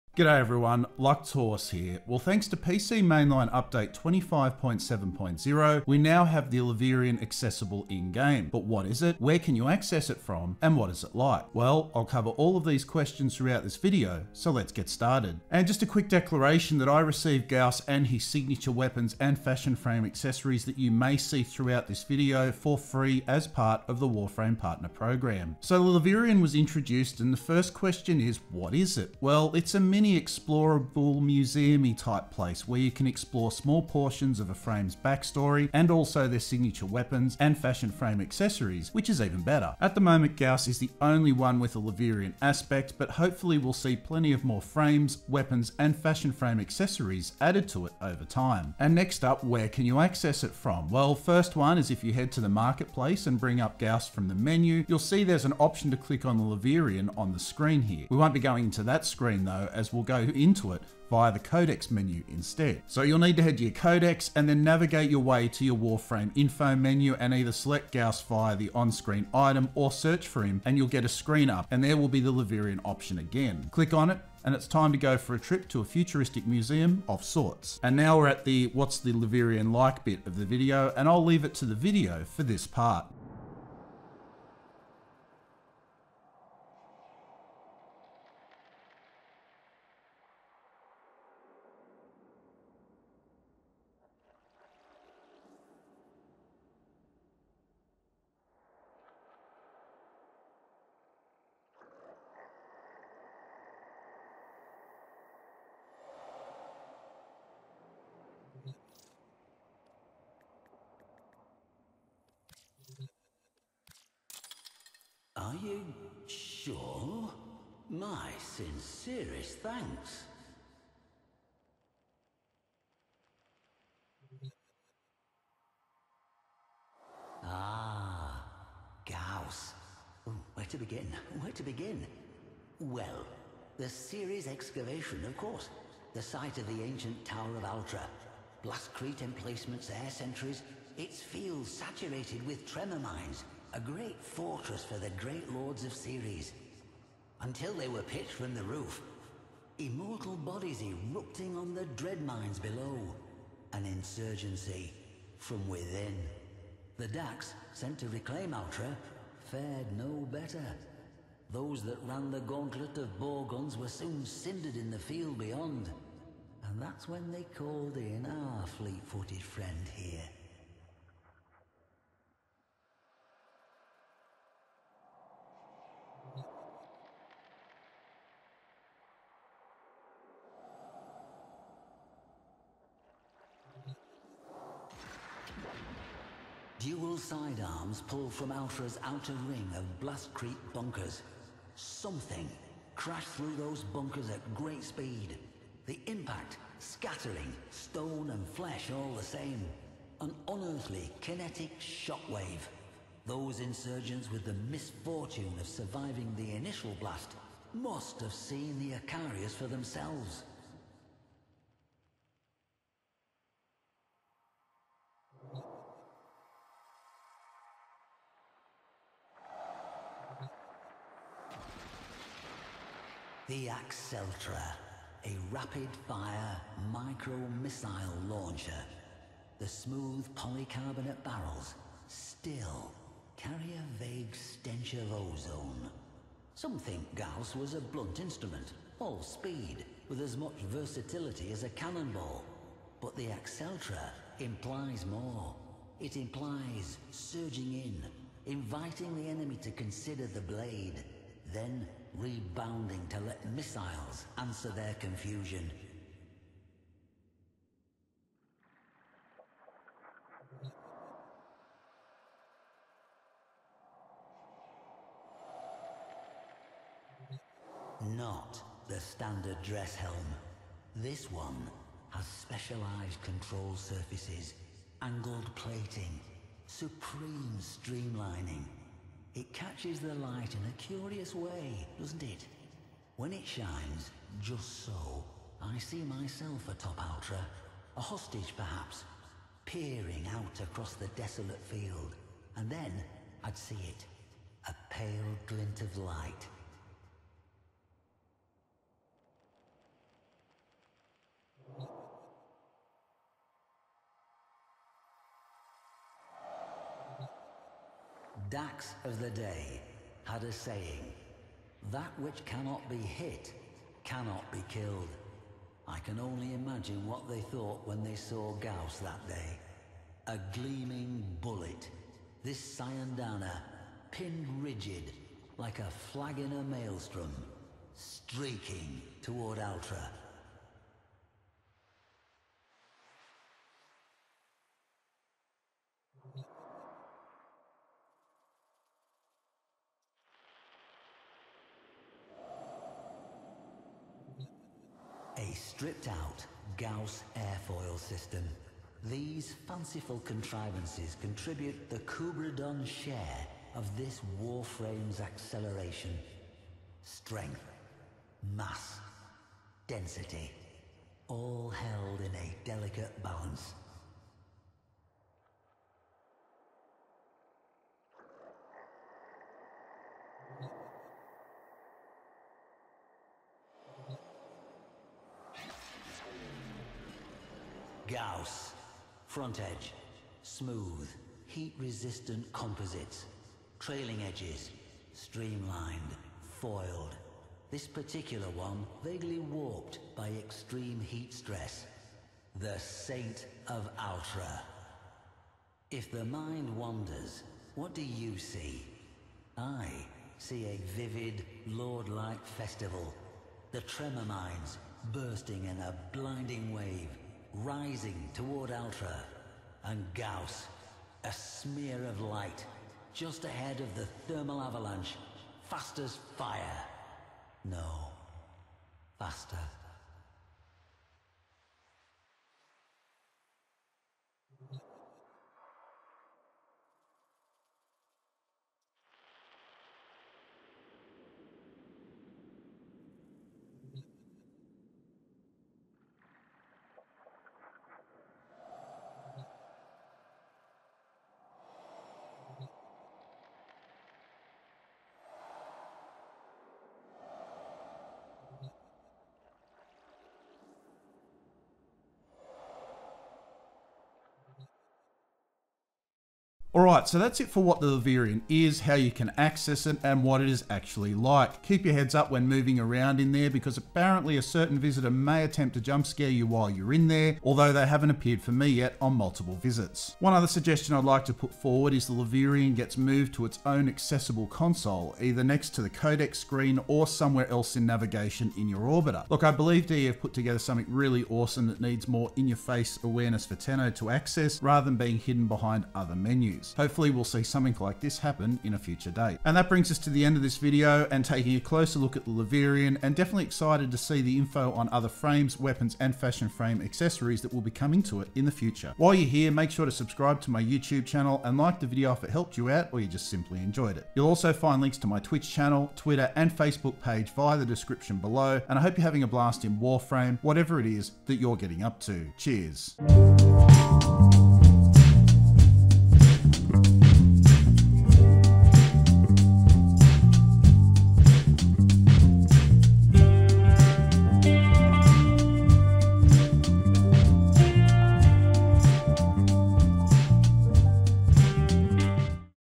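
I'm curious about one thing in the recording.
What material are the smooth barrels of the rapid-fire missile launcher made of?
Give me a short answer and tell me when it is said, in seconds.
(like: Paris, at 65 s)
Polycarbonate, at 230 s.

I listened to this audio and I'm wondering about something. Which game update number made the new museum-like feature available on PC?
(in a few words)
25.7.0.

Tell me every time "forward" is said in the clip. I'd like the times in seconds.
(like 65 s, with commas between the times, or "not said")
471 s.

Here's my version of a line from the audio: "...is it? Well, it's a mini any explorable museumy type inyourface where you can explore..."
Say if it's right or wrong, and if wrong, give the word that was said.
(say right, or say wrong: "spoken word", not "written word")
wrong: "place", not "inyourface".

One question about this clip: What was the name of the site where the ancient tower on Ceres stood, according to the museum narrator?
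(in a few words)
Ceres excavation.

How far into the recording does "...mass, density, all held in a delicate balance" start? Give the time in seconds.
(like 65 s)
358 s.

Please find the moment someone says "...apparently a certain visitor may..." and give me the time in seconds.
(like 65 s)
463 s.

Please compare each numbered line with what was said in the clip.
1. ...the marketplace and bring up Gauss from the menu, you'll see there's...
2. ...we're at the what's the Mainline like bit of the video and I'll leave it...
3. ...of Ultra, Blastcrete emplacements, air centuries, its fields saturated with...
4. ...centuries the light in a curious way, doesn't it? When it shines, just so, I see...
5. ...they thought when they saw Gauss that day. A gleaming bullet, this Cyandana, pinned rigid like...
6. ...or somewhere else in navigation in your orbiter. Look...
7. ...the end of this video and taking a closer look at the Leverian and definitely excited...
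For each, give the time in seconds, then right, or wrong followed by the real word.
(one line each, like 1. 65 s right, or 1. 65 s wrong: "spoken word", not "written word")
1. 52 s right
2. 78 s wrong: "Leverian", not "Mainline"
3. 137 s right
4. 279 s wrong: "catches", not "centuries"
5. 317 s right
6. 476 s right
7. 490 s right.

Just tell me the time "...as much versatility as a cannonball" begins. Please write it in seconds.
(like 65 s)
240 s.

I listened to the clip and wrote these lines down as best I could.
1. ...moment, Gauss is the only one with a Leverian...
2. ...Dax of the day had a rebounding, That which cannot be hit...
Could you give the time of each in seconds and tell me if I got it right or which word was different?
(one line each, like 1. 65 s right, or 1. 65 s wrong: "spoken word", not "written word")
1. 40 s right
2. 308 s wrong: "saying", not "rebounding".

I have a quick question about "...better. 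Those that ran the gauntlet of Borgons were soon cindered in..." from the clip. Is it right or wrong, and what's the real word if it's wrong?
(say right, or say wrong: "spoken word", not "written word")
right.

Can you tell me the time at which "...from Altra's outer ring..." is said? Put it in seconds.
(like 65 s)
188 s.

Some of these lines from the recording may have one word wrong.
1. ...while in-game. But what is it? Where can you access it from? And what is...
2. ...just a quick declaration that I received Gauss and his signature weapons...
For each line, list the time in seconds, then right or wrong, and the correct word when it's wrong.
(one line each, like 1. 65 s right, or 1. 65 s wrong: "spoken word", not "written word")
1. 7 s wrong: "accessible", not "while"
2. 15 s right.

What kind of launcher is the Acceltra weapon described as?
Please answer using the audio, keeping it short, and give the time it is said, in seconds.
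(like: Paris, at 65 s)
Micro-missile launcher, at 226 s.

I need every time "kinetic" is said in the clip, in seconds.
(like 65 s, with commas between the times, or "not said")
201 s.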